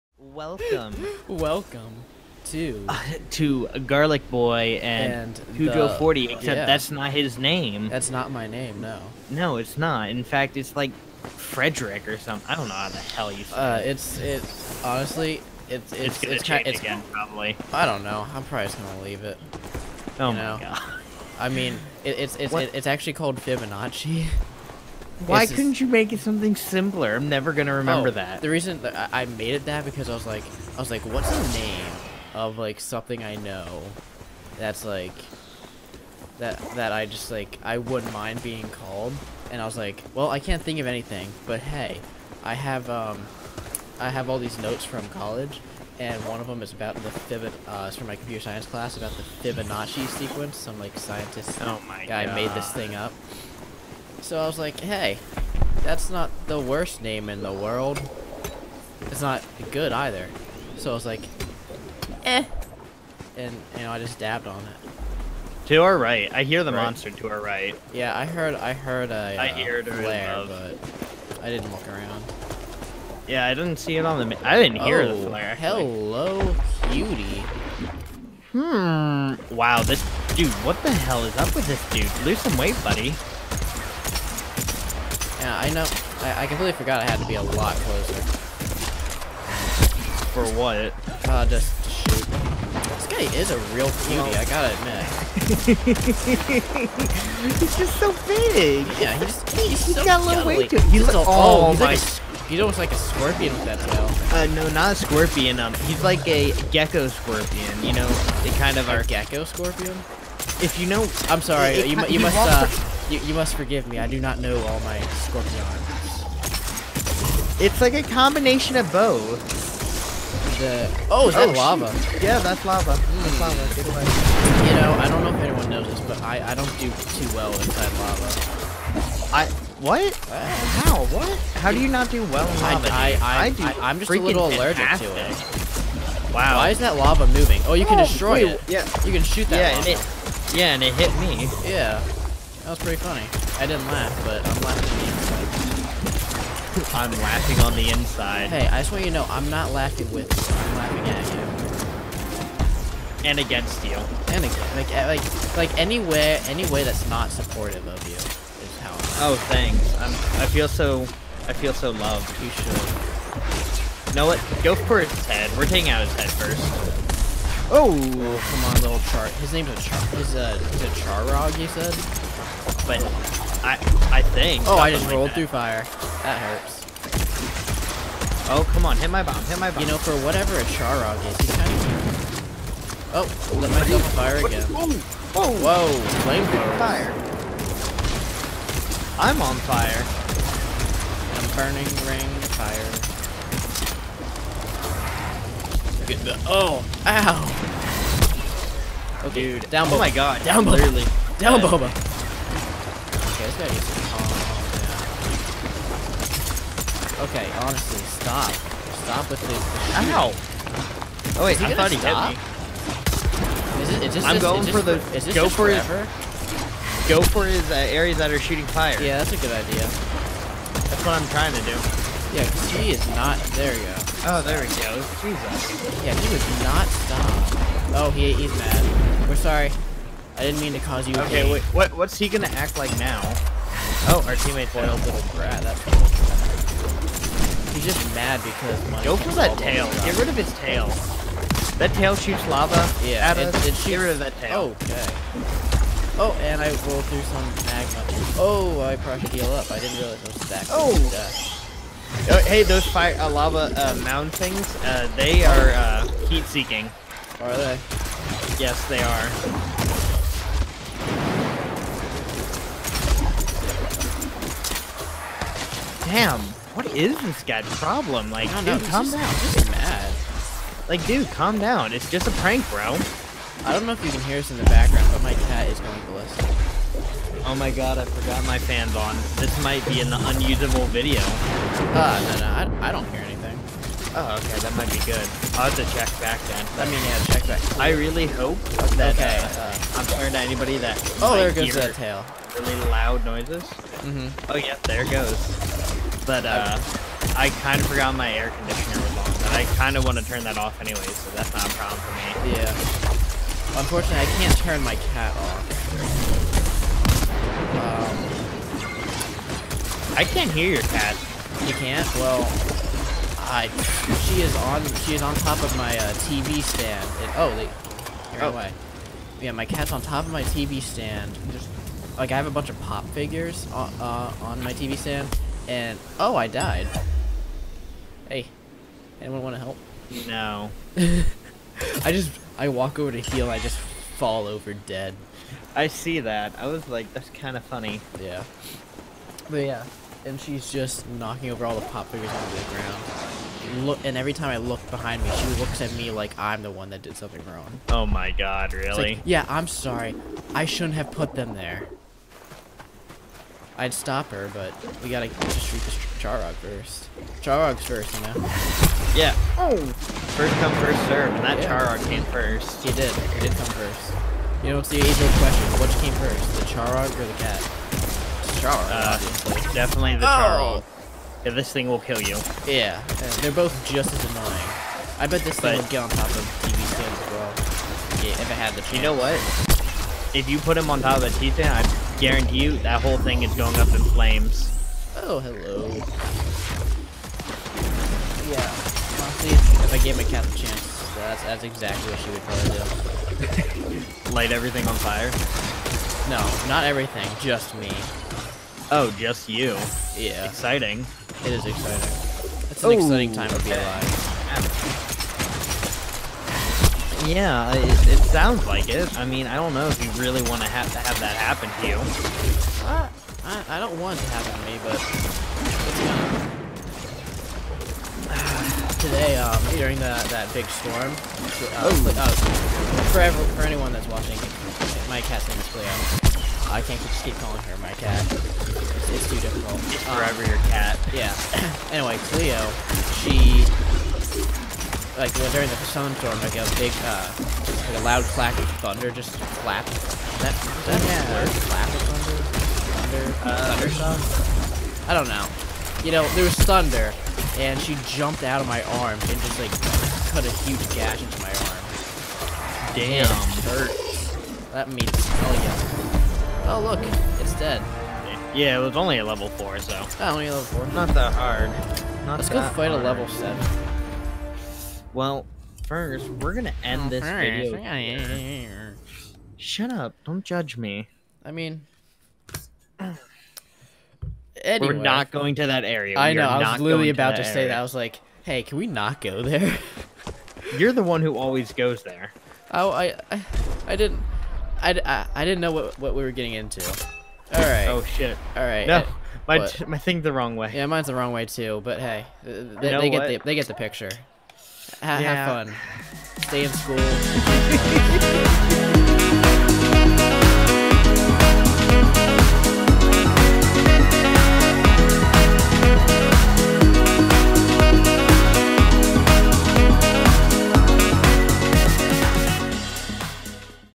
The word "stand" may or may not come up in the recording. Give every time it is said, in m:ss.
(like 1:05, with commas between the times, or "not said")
5:16, 5:20, 5:24, 6:16.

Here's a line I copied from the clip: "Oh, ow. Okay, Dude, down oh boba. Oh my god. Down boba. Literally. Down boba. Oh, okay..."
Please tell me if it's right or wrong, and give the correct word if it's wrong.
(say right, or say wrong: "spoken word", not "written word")
right.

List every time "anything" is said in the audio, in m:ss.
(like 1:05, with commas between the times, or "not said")
0:40, 4:43.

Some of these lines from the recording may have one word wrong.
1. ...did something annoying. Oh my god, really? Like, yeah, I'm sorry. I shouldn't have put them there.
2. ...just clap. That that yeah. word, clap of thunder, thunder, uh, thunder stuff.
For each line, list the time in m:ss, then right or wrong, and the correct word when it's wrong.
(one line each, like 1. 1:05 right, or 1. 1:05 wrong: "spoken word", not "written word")
1. 5:47 wrong: "wrong", not "annoying"
2. 7:19 right.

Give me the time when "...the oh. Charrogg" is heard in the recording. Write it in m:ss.
6:10.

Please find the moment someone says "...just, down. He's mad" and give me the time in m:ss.
4:29.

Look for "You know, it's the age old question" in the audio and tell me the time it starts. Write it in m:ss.
6:04.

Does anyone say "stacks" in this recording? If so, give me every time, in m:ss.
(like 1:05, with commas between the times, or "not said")
4:10.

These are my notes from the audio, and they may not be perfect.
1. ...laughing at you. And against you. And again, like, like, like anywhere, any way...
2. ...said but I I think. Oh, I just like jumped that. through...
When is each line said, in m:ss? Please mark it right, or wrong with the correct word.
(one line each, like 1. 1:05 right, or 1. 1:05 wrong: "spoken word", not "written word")
1. 2:30 right
2. 2:51 wrong: "rolled", not "jumped".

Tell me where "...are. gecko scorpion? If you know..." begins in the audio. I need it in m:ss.
1:48.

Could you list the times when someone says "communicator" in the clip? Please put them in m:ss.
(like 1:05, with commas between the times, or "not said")
not said.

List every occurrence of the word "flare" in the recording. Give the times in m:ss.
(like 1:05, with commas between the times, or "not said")
1:09, 1:15.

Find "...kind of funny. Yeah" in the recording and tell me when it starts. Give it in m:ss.
5:37.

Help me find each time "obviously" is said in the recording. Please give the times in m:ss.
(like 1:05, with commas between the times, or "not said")
6:09.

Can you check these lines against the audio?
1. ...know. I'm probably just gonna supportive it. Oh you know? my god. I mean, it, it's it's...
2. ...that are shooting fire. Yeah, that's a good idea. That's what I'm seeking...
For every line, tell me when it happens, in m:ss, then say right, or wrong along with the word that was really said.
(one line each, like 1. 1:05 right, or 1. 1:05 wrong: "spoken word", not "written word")
1. 0:18 wrong: "leave", not "supportive"
2. 3:38 wrong: "trying", not "seeking".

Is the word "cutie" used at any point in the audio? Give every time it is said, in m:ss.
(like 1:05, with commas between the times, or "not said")
1:16, 1:34.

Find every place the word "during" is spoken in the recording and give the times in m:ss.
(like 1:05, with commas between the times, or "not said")
6:59, 7:15.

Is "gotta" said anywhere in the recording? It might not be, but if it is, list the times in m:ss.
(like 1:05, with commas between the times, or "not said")
1:34, 5:55.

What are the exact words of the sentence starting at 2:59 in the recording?
You know, for whatever a Charrogg is, he's kind of...